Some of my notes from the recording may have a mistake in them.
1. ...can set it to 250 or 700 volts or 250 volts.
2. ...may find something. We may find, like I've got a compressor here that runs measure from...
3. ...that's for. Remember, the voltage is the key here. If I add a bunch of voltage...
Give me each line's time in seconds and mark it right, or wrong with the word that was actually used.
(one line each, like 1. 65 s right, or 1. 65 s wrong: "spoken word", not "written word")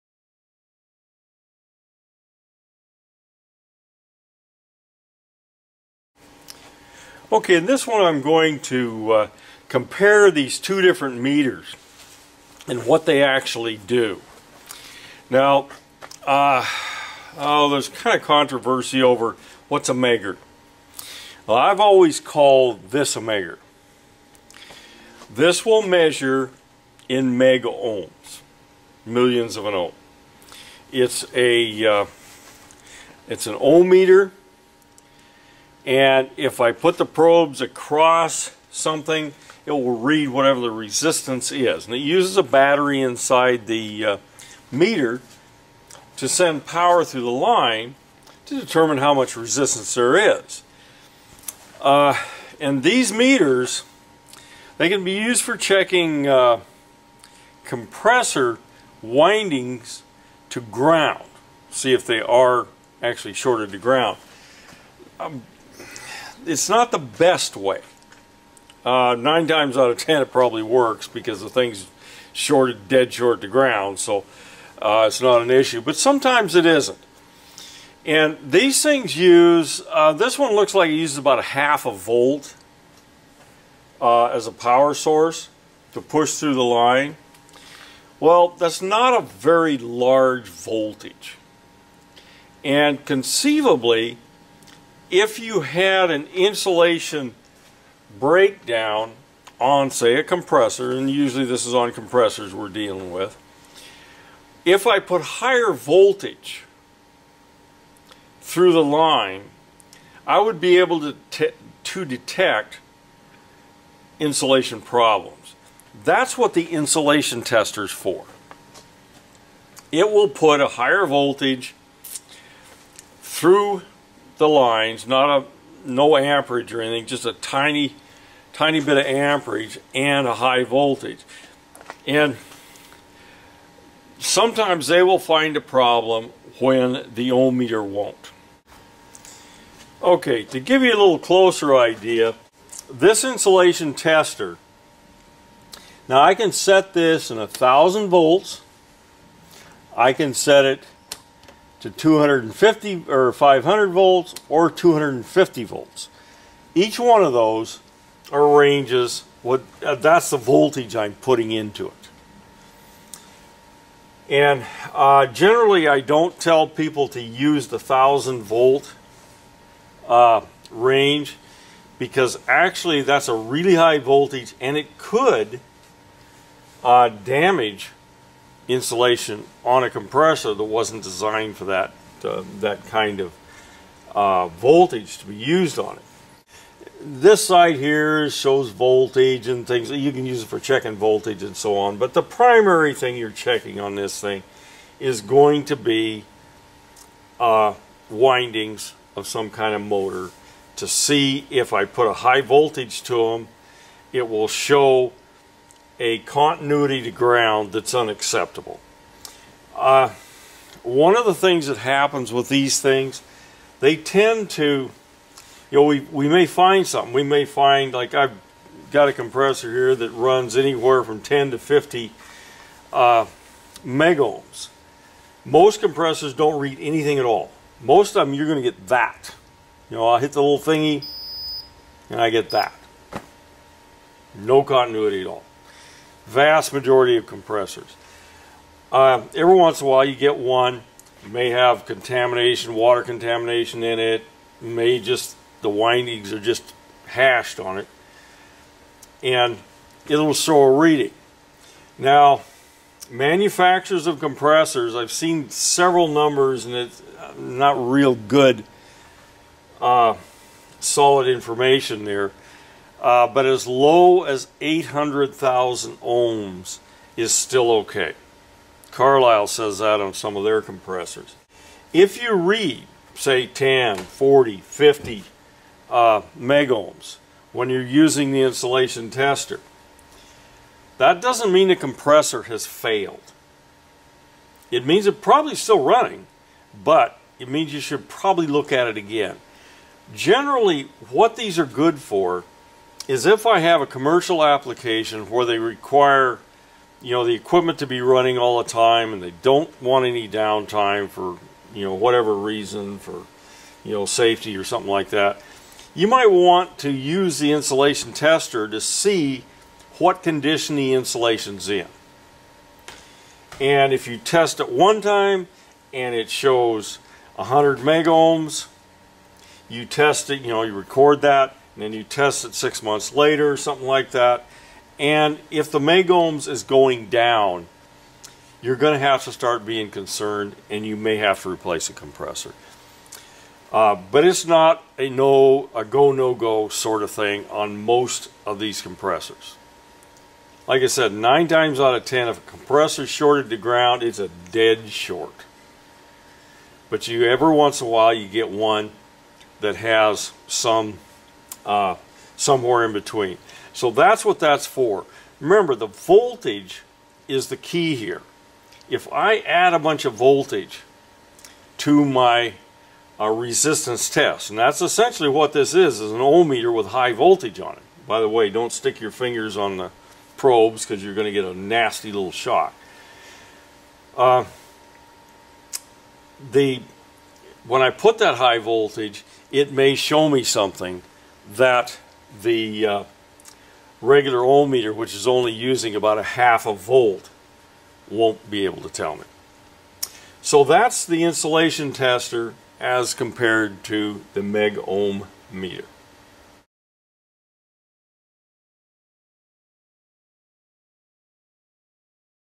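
1. 150 s wrong: "500", not "700"
2. 216 s wrong: "anywhere", not "measure"
3. 354 s right.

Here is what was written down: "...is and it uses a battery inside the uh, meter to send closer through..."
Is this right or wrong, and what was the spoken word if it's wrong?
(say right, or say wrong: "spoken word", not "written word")
wrong: "power", not "closer".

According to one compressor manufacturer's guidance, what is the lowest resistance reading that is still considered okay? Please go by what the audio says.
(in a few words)
800,000 ohms.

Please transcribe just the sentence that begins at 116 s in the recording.
That's what the insulation tester is for.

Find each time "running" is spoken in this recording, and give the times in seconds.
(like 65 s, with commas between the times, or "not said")
285 s, 297 s.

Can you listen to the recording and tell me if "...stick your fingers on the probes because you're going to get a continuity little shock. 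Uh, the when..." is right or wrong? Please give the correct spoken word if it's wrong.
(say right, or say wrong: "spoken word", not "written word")
wrong: "nasty", not "continuity".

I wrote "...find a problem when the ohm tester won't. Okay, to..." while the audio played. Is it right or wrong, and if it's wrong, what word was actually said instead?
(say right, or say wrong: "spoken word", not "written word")
wrong: "meter", not "tester".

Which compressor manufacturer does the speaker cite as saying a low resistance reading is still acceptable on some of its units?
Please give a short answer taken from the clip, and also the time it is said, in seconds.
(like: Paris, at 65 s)
Carlyle, at 268 s.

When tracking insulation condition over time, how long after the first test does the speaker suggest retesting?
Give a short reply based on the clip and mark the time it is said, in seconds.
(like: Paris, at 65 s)
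six months, at 322 s.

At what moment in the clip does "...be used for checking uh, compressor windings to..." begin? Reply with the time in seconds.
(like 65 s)
55 s.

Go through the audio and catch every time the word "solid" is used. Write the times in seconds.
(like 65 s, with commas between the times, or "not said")
260 s.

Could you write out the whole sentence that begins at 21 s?
Well, I've always called this a megger.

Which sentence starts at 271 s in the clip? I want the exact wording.
If you read, say, 10, 40, 50 uh, megohms when you're using the insulation tester, that doesn't mean the compressor has failed.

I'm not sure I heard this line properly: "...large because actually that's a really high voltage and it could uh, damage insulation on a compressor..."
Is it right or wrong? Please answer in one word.
wrong.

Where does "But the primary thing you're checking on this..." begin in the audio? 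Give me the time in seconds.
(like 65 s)
191 s.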